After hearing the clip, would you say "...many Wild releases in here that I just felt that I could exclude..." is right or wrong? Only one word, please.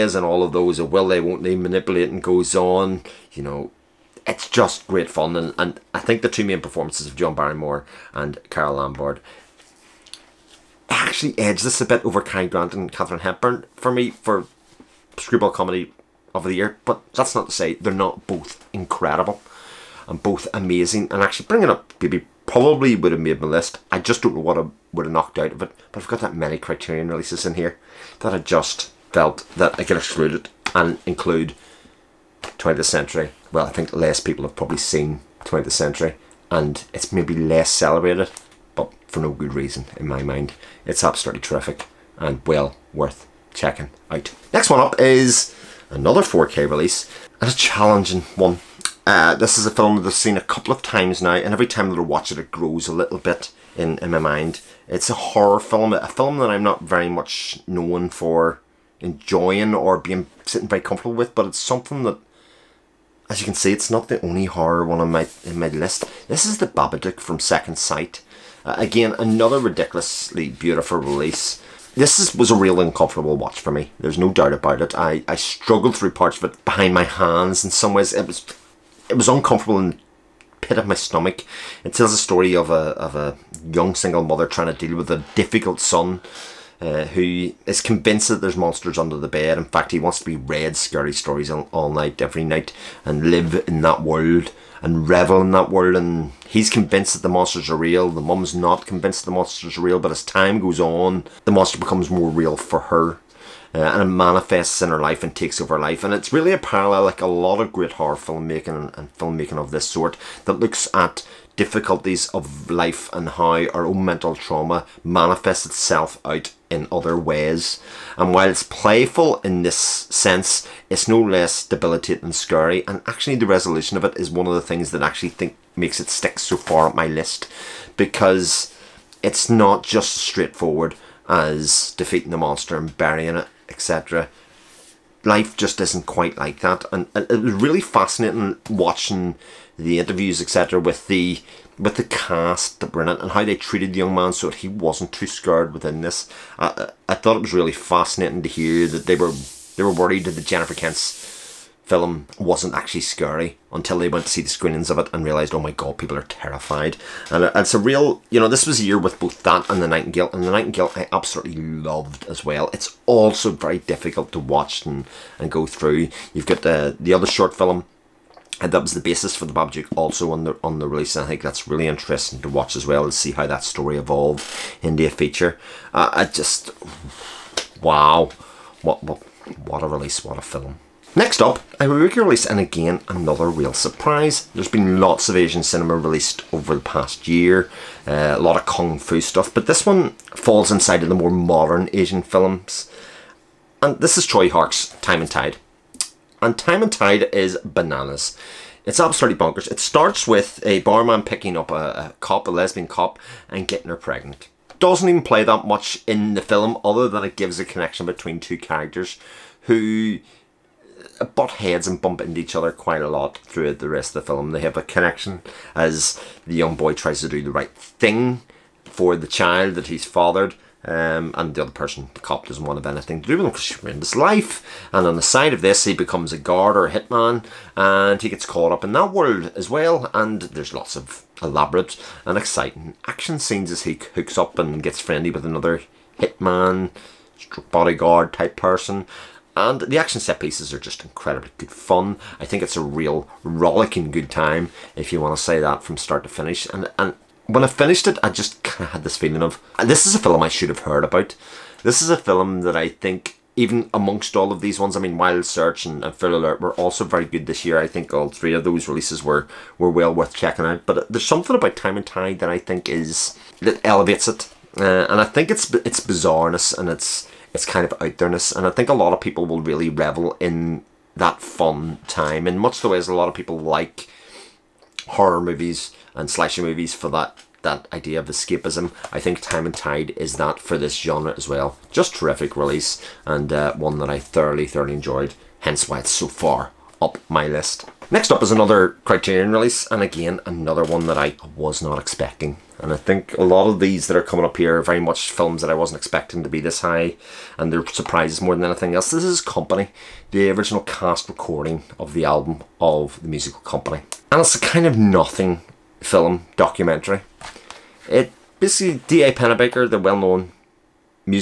wrong.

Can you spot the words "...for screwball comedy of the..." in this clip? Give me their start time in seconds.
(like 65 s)
14 s.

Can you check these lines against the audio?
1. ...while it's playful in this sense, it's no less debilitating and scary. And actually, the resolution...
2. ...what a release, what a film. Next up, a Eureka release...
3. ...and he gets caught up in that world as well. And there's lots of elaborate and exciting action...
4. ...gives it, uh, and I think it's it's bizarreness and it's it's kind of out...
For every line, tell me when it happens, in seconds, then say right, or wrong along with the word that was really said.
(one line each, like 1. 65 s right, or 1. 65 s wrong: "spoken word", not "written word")
1. 118 s right
2. 179 s right
3. 227 s right
4. 263 s wrong: "elevates", not "gives".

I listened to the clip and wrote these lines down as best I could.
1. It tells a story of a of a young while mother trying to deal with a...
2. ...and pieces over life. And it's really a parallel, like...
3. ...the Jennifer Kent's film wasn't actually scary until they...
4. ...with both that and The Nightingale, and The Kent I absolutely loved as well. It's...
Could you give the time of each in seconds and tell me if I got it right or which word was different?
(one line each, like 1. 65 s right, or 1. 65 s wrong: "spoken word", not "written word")
1. 81 s wrong: "single", not "while"
2. 105 s wrong: "takes", not "pieces"
3. 150 s right
4. 158 s wrong: "Nightingale", not "Kent".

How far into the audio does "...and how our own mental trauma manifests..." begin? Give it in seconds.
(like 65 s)
113 s.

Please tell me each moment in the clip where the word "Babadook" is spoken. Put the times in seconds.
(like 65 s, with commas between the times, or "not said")
66 s, 169 s.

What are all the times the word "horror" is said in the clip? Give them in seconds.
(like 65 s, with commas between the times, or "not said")
55 s, 64 s, 107 s, 275 s.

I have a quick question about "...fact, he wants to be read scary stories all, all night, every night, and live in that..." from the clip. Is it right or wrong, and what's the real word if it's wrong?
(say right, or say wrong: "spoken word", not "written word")
right.